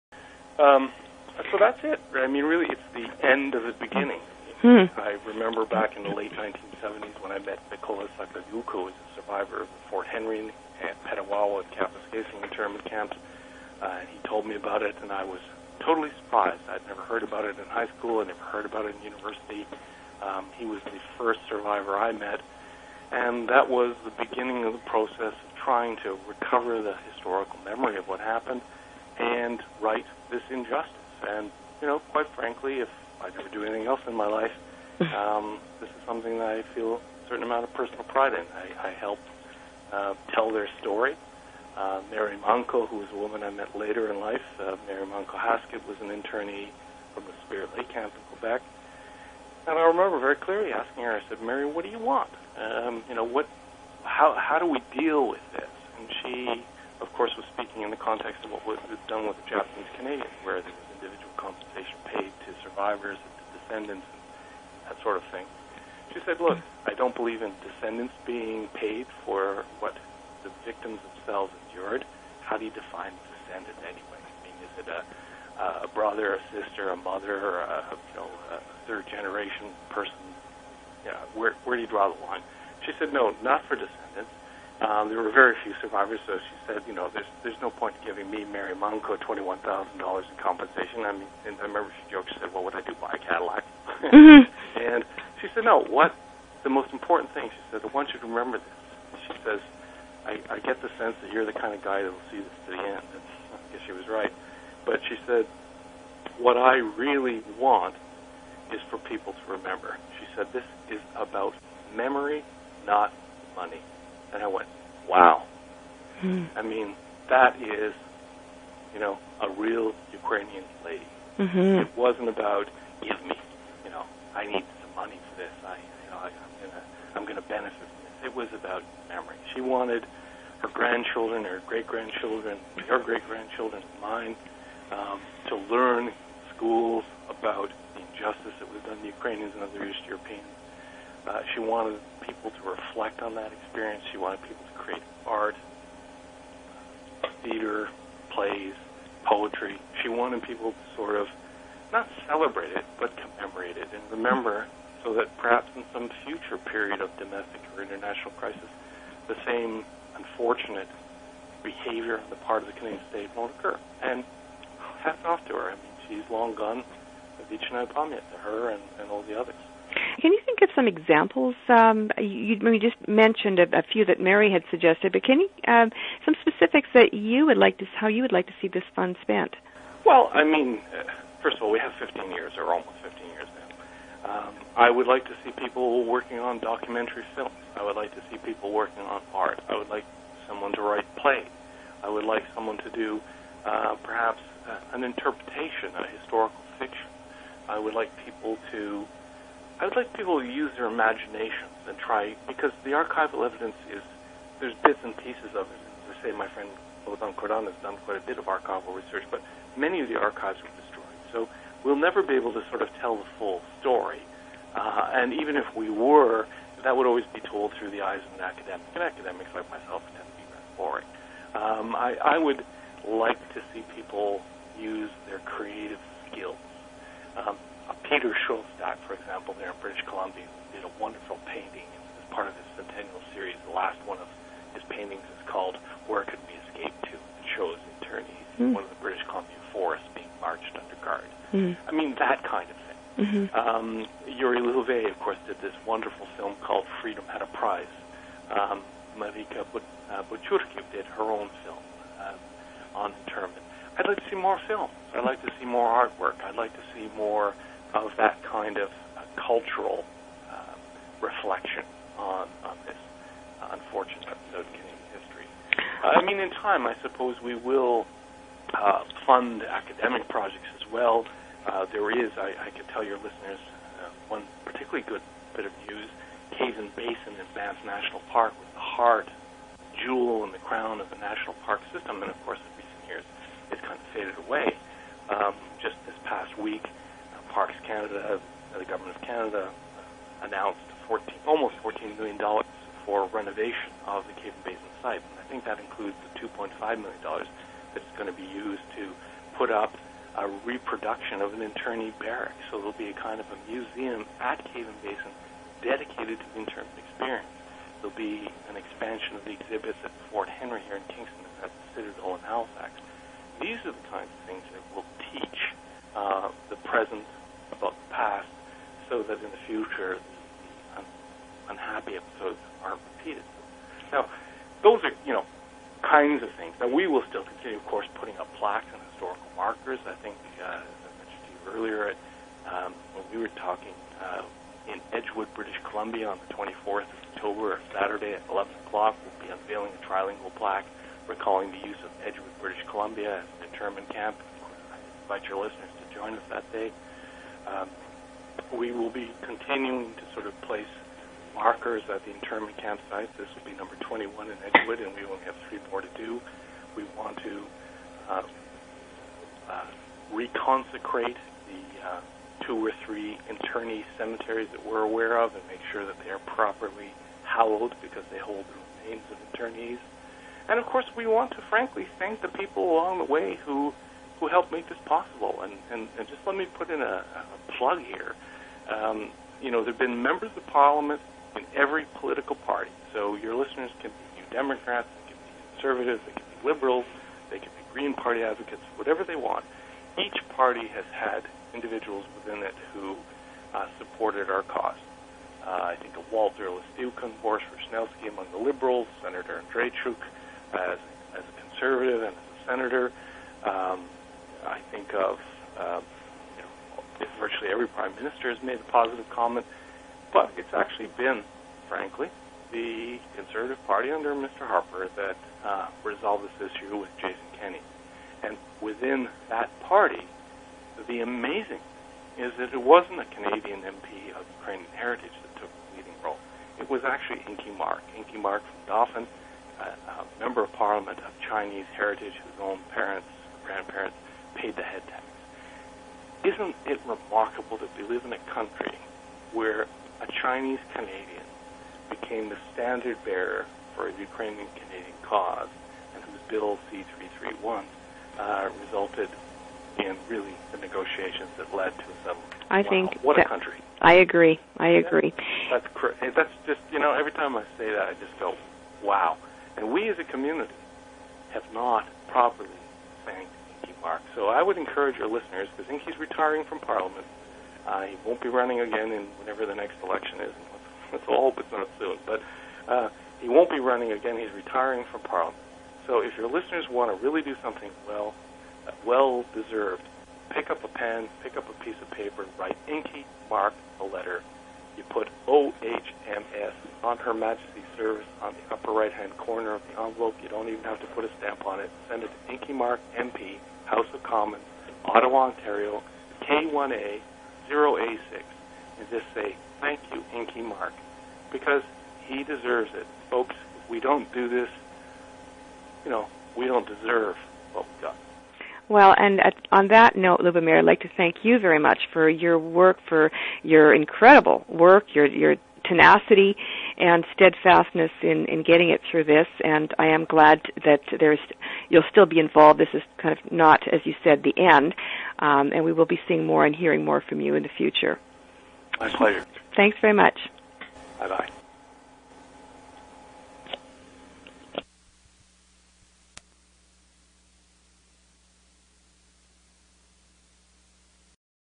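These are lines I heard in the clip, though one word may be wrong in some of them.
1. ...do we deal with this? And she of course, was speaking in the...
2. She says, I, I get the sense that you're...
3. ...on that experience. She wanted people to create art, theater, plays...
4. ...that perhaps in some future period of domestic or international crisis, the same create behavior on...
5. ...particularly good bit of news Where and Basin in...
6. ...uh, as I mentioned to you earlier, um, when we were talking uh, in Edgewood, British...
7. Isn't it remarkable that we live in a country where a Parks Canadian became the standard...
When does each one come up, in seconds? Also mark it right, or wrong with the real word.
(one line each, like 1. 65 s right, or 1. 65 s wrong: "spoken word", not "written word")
1. 54 s right
2. 99 s right
3. 143 s right
4. 155 s wrong: "unfortunate", not "create"
5. 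274 s wrong: "Caves", not "Where"
6. 330 s right
7. 436 s wrong: "Chinese", not "Parks".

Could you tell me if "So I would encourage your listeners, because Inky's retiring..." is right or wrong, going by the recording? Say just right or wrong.
right.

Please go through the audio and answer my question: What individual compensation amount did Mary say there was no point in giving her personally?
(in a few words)
$21,000.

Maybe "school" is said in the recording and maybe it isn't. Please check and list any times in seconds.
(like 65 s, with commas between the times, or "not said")
17 s, 136 s.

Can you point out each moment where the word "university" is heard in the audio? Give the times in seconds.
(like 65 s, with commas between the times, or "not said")
19 s.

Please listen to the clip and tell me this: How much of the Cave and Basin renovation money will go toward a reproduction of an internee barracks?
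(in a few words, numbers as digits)
$2.5 million.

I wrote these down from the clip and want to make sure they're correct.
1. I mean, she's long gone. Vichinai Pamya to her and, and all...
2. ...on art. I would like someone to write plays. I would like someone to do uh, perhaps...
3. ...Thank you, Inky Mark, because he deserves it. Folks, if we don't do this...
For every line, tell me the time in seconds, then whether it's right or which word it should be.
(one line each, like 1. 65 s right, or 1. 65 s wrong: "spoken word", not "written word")
1. 165 s right
2. 189 s right
3. 499 s right.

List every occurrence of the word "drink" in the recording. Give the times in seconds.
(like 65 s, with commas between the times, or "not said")
not said.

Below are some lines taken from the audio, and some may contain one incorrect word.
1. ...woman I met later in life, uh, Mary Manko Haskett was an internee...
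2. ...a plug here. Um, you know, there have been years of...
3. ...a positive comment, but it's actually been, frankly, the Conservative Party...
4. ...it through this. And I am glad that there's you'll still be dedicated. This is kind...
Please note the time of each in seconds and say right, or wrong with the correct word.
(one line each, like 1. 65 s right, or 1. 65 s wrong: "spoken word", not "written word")
1. 43 s right
2. 377 s wrong: "members", not "years"
3. 408 s right
4. 518 s wrong: "involved", not "dedicated".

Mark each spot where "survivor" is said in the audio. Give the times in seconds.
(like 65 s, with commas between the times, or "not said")
9 s, 21 s, 62 s, 85 s.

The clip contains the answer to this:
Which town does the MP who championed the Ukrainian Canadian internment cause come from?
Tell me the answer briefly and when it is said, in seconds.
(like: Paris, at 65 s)
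Dauphin, at 428 s.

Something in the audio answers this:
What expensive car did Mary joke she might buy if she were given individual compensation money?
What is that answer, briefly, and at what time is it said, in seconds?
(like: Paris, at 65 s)
Cadillac, at 92 s.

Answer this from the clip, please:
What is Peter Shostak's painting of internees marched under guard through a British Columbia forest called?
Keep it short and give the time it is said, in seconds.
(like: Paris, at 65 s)
Where Could We Escape To?, at 236 s.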